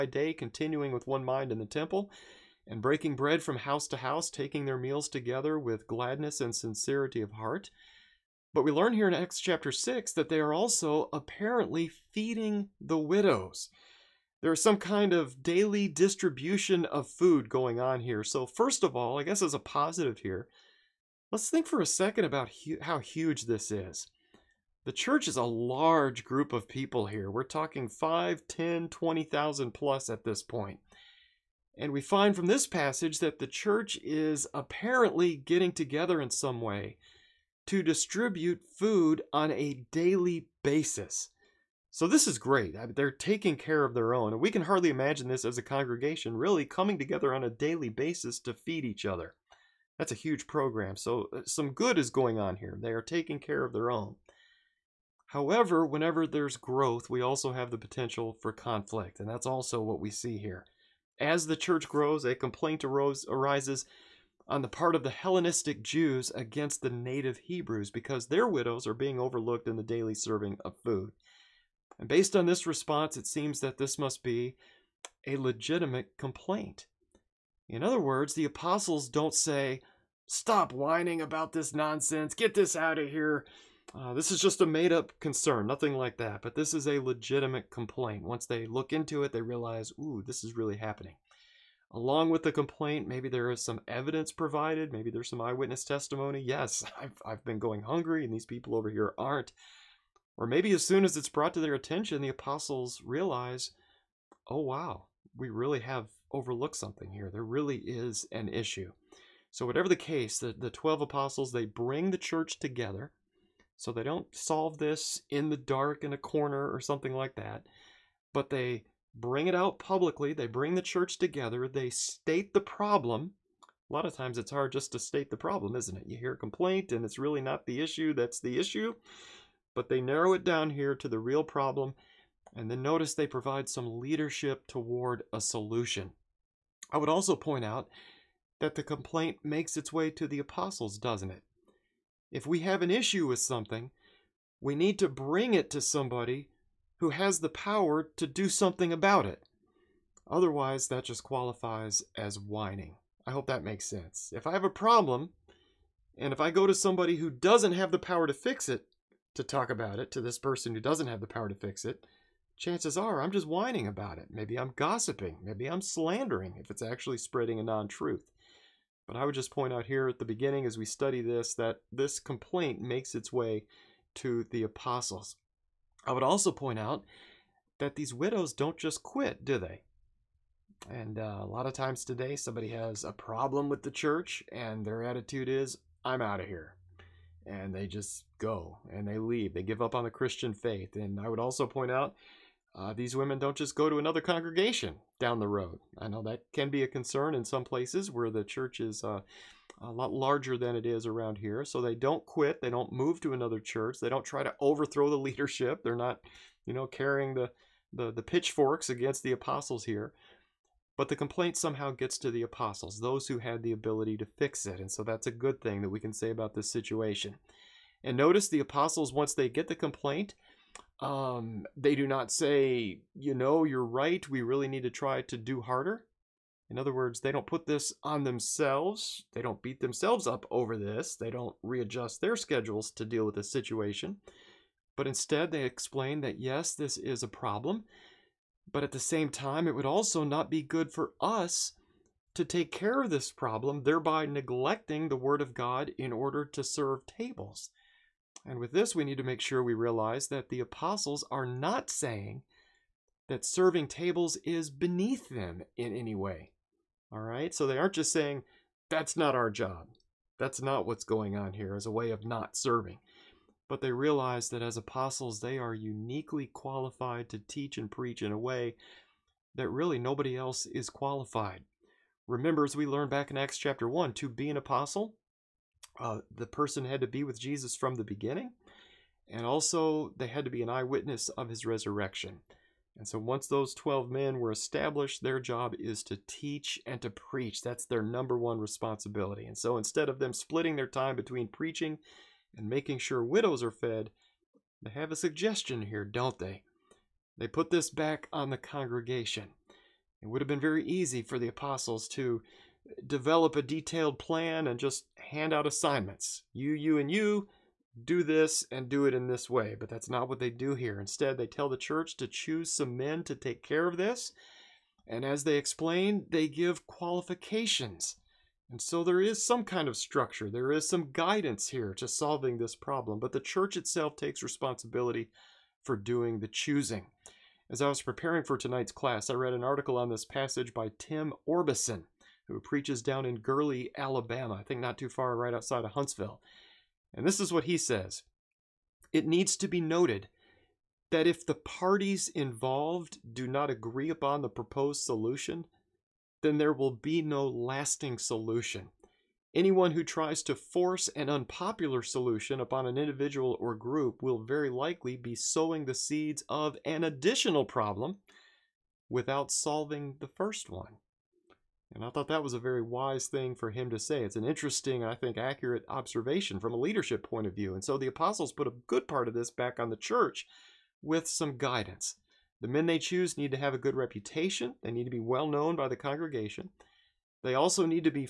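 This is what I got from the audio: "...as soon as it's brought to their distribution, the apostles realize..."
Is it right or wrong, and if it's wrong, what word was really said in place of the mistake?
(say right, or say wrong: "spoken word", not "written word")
wrong: "attention", not "distribution".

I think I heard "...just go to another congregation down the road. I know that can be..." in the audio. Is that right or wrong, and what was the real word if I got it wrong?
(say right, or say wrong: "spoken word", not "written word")
right.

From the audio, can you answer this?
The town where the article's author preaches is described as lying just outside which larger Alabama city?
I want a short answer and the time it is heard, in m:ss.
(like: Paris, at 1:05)
Huntsville, at 5:35.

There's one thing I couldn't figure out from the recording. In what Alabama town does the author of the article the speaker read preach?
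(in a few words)
Gurley.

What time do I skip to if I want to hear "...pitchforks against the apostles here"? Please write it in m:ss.
3:28.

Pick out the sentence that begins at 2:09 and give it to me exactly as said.
But they narrow it down here to the real problem.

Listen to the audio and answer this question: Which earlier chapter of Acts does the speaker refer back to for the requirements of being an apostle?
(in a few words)
Acts chapter 1.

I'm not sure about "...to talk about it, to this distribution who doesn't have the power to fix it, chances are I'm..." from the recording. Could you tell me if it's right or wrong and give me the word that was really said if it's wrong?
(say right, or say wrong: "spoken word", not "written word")
wrong: "person", not "distribution".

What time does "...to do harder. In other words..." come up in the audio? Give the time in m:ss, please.
3:45.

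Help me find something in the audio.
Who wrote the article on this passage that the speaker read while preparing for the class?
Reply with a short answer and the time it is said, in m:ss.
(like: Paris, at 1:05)
Tim Orbison, at 5:30.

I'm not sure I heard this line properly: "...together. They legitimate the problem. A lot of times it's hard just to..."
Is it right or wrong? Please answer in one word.
wrong.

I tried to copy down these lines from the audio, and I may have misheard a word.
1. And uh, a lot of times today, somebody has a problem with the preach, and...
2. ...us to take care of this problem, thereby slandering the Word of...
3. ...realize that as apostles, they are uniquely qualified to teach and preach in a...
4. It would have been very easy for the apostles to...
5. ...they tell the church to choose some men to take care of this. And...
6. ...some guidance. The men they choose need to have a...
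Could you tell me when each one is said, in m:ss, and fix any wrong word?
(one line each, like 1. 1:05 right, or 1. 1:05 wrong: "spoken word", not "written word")
1. 3:00 wrong: "church", not "preach"
2. 4:01 wrong: "neglecting", not "slandering"
3. 4:23 right
4. 5:00 right
5. 5:11 right
6. 6:11 right.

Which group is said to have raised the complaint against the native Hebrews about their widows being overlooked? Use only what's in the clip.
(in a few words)
Hellenistic Jews.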